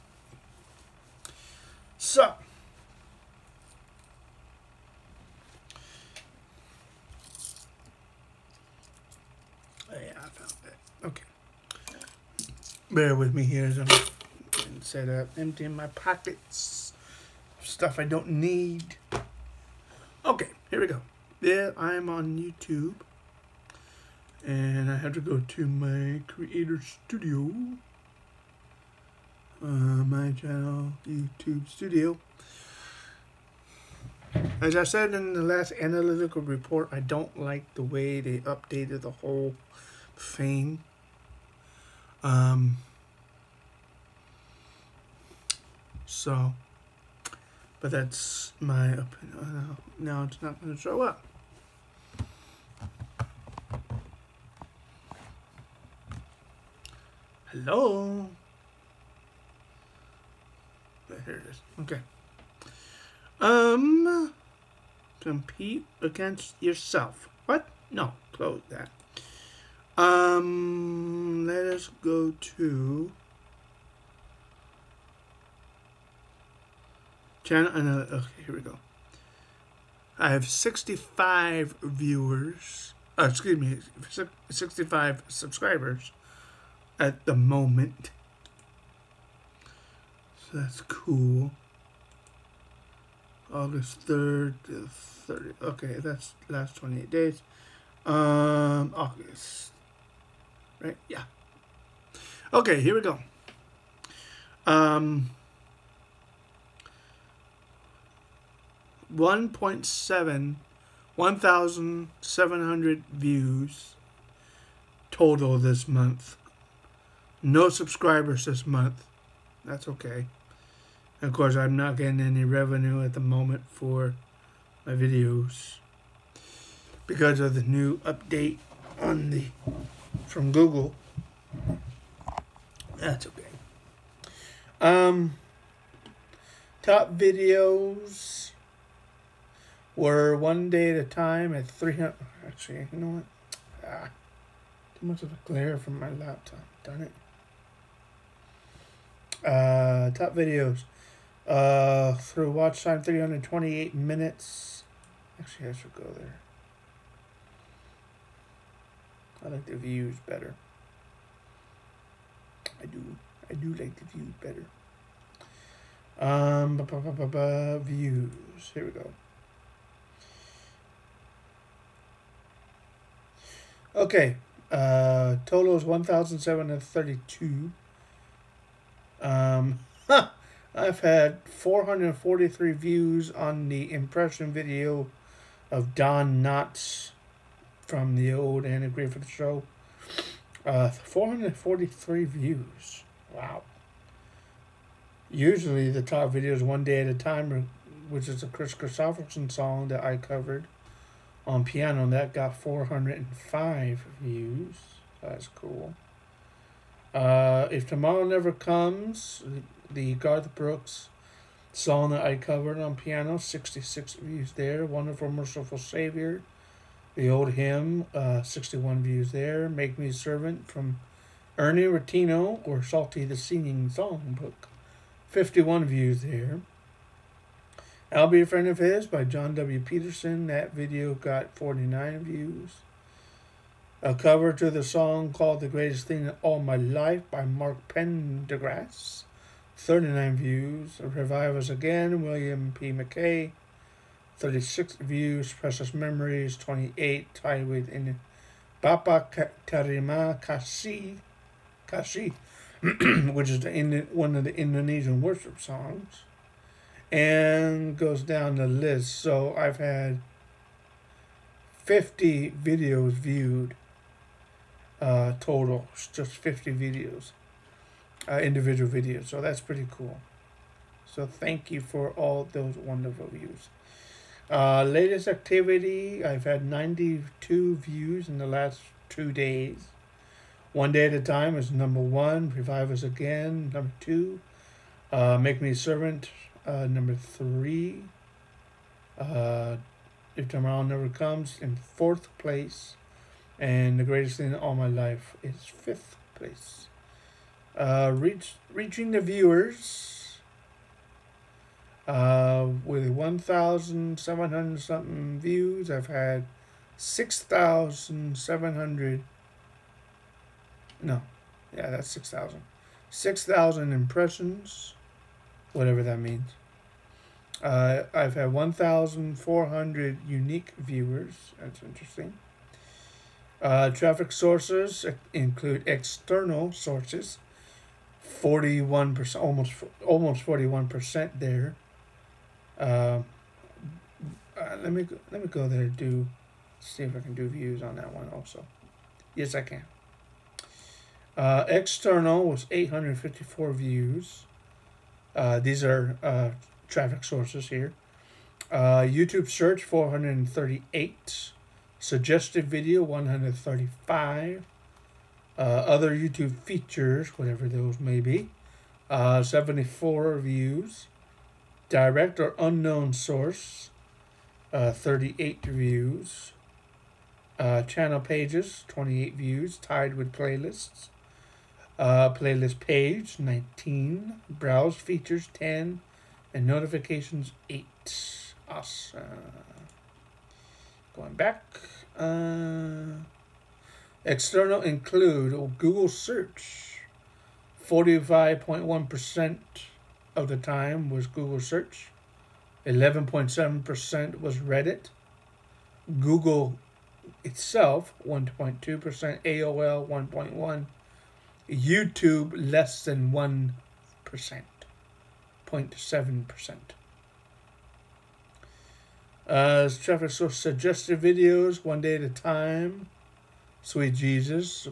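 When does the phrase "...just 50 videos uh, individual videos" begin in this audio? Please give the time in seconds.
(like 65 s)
266 s.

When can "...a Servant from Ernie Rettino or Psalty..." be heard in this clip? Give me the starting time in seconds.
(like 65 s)
220 s.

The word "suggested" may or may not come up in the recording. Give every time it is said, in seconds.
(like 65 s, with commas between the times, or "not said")
351 s, 410 s.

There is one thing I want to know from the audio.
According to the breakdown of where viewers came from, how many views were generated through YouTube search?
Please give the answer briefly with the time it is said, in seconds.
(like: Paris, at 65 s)
438, at 349 s.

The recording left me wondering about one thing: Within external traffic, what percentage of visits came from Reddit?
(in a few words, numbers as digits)
11.7%.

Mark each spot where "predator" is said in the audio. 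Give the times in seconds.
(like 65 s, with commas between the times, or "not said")
not said.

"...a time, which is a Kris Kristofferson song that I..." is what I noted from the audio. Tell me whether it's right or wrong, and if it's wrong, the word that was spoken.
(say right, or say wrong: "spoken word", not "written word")
right.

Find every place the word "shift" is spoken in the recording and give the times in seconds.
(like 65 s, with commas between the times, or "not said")
not said.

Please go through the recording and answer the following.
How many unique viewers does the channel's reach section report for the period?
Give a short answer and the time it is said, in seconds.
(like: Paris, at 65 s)
1,400, at 318 s.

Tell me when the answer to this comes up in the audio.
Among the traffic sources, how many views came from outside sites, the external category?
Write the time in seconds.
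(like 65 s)
342 s.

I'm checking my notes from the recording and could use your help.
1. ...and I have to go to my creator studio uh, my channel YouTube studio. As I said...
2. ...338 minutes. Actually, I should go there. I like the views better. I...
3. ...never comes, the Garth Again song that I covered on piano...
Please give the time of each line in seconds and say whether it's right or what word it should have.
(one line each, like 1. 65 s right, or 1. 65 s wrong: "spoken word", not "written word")
1. 24 s right
2. 153 s wrong: "328", not "338"
3. 208 s wrong: "Brooks", not "Again".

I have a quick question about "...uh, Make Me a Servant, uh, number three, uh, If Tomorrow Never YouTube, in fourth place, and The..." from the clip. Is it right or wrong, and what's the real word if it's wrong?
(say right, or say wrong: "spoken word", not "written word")
wrong: "Comes", not "YouTube".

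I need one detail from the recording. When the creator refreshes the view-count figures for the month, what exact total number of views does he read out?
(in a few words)
1,732.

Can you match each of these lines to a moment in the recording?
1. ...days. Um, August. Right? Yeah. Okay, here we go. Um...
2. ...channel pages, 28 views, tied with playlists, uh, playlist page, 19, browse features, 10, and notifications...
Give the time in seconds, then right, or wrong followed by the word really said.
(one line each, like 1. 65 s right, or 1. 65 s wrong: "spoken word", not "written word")
1. 97 s right
2. 367 s right.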